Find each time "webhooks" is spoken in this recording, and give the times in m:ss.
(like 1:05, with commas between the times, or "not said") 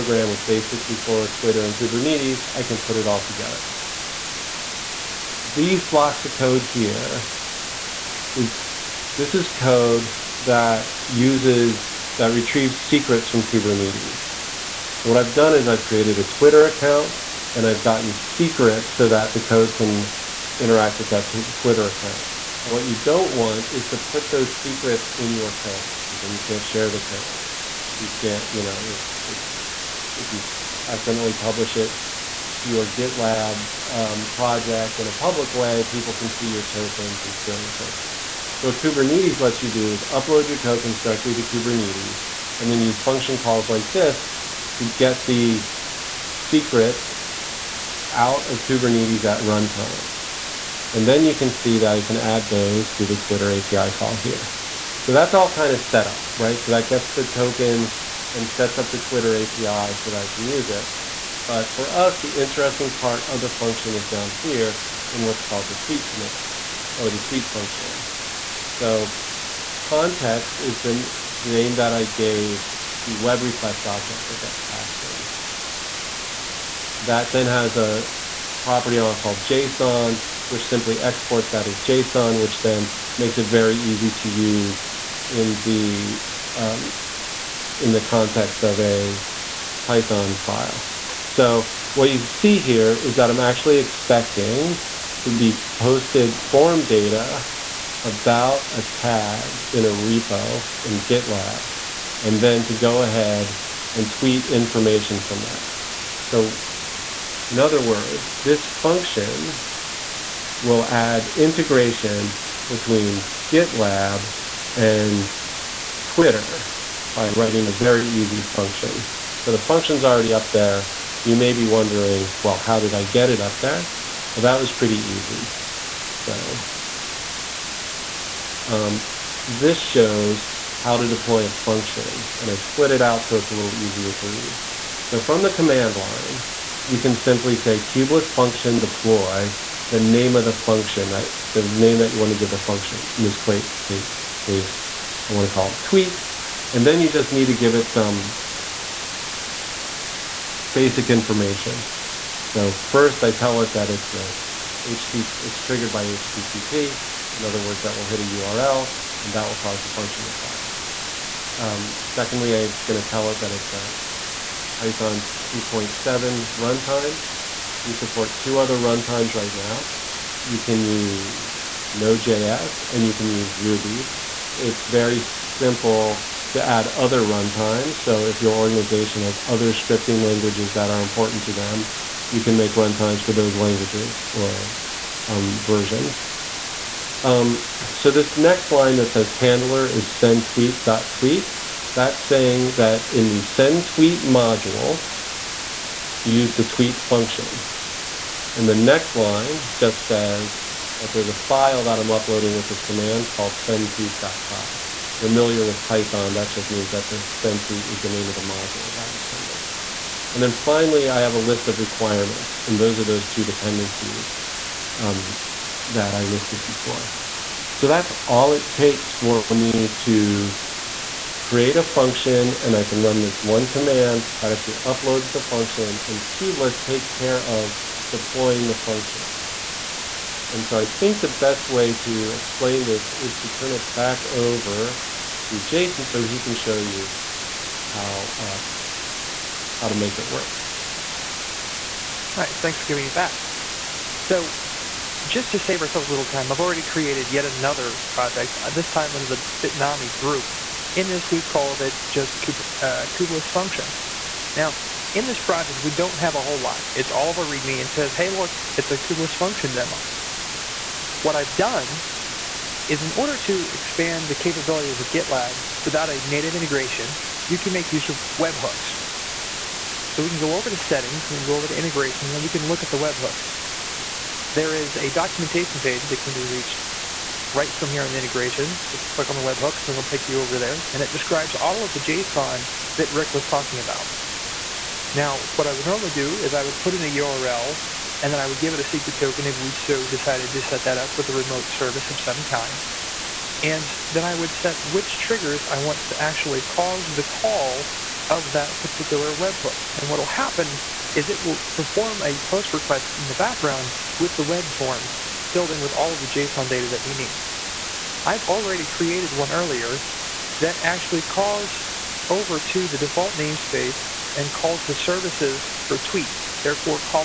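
4:28, 4:32, 4:39, 4:59.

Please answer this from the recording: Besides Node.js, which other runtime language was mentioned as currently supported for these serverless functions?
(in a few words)
Ruby.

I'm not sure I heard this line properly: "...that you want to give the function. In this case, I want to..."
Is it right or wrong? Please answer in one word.
right.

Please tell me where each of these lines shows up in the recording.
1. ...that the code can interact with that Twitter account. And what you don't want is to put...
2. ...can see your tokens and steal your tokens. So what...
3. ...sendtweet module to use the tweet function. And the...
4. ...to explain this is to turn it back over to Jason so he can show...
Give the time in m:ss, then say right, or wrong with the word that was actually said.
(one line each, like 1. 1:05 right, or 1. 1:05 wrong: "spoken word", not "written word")
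1. 0:19 right
2. 0:36 right
3. 3:13 right
4. 3:51 right.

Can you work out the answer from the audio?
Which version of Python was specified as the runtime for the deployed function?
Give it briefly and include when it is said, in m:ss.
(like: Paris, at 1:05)
2.7, at 2:45.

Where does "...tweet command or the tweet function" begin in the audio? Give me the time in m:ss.
1:05.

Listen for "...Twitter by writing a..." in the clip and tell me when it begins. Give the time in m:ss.
1:56.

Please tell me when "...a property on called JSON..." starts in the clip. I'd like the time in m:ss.
1:17.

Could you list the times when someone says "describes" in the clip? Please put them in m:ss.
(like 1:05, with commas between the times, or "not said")
4:41.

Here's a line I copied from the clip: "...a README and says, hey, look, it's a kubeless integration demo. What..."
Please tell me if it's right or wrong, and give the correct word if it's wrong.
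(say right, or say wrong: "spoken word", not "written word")
wrong: "function", not "integration".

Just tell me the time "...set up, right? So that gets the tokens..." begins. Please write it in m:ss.
0:55.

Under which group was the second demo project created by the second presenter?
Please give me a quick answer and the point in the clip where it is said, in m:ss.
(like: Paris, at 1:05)
Bitnami, at 4:09.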